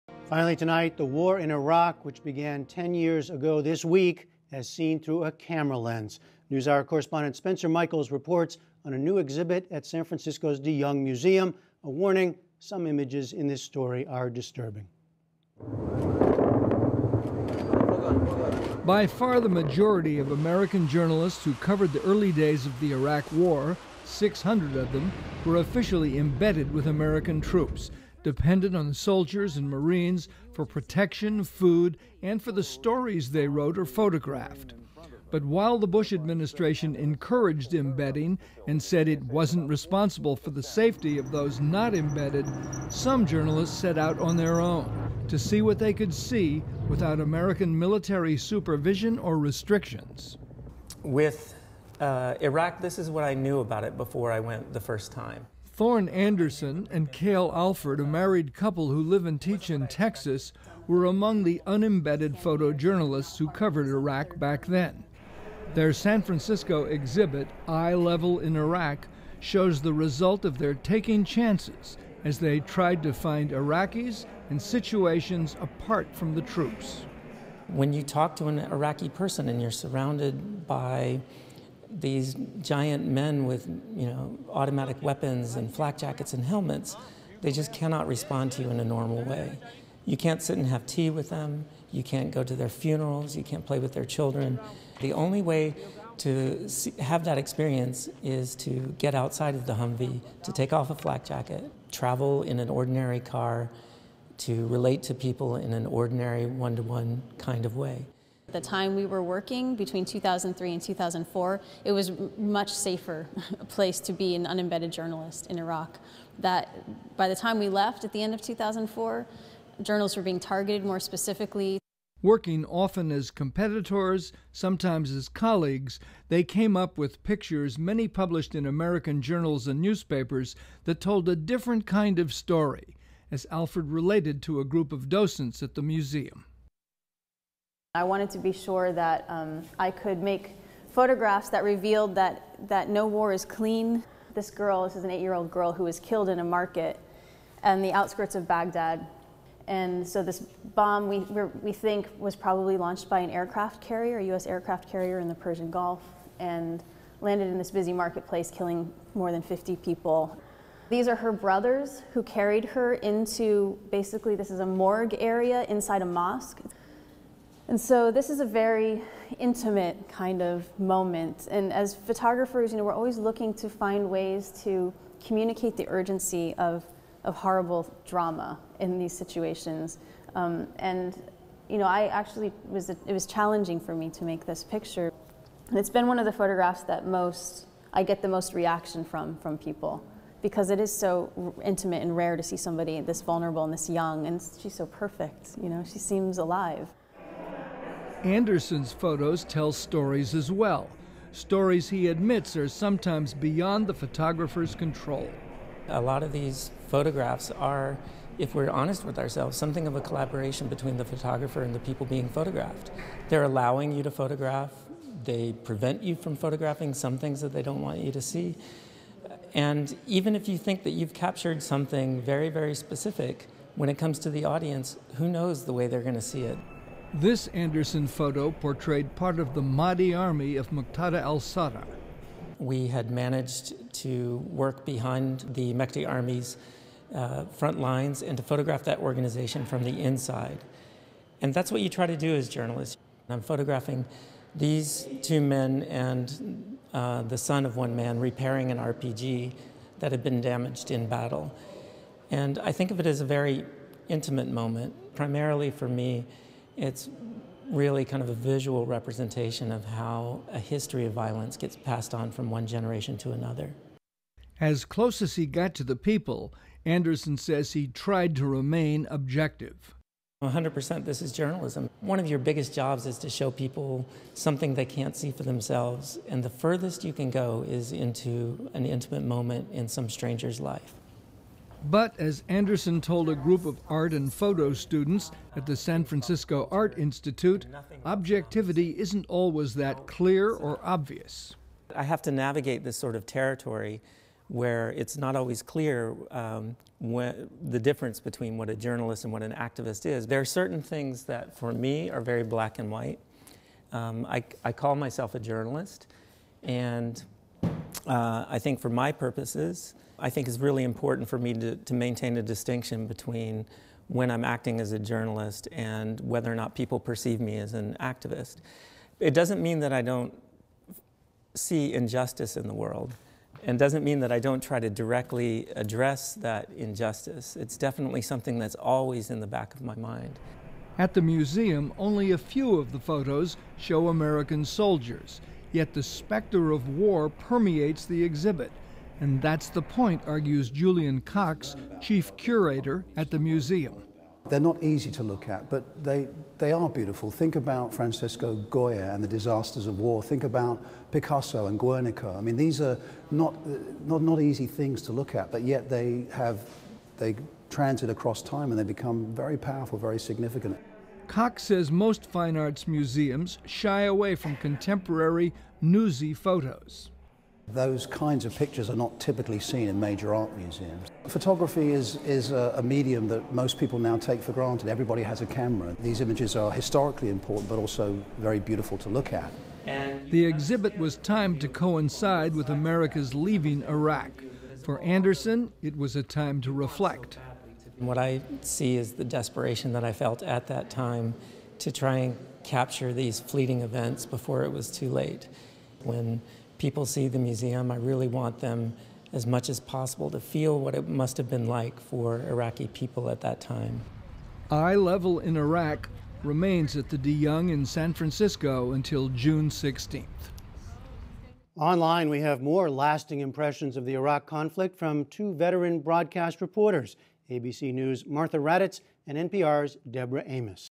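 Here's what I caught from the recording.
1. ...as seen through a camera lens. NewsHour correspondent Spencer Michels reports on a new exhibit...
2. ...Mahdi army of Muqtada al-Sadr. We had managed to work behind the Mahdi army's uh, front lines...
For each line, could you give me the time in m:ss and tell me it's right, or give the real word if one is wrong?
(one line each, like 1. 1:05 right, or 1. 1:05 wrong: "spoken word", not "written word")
1. 0:04 right
2. 3:49 right.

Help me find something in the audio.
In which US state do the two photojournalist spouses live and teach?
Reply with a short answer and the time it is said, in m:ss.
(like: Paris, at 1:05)
Texas, at 0:59.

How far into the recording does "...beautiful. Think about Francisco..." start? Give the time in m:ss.
5:46.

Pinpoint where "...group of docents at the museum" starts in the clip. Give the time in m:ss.
2:14.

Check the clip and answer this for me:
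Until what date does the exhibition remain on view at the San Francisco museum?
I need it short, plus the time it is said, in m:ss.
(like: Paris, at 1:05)
June 16th, at 6:49.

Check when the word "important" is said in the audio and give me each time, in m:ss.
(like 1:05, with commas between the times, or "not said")
5:10, 6:17.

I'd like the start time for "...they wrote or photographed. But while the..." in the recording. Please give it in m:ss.
0:33.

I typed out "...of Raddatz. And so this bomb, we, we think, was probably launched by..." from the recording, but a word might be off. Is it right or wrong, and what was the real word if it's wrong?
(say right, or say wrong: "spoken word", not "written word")
wrong: "Baghdad", not "Raddatz".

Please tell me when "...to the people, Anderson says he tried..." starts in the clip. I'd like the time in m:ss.
4:25.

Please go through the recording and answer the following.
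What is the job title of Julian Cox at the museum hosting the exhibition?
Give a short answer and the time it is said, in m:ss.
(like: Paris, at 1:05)
Chief curator, at 5:42.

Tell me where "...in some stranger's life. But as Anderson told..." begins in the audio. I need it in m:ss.
4:39.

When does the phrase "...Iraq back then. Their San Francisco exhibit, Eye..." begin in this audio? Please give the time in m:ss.
1:03.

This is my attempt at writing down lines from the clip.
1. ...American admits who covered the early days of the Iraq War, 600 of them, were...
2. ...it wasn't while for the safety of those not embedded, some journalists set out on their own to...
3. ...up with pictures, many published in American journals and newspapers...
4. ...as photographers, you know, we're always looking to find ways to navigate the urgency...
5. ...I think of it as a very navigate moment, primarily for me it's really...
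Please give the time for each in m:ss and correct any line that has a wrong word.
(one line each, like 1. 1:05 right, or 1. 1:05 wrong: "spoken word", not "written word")
1. 0:20 wrong: "journalists", not "admits"
2. 0:39 wrong: "responsible", not "while"
3. 2:06 right
4. 2:51 wrong: "communicate", not "navigate"
5. 4:12 wrong: "intimate", not "navigate".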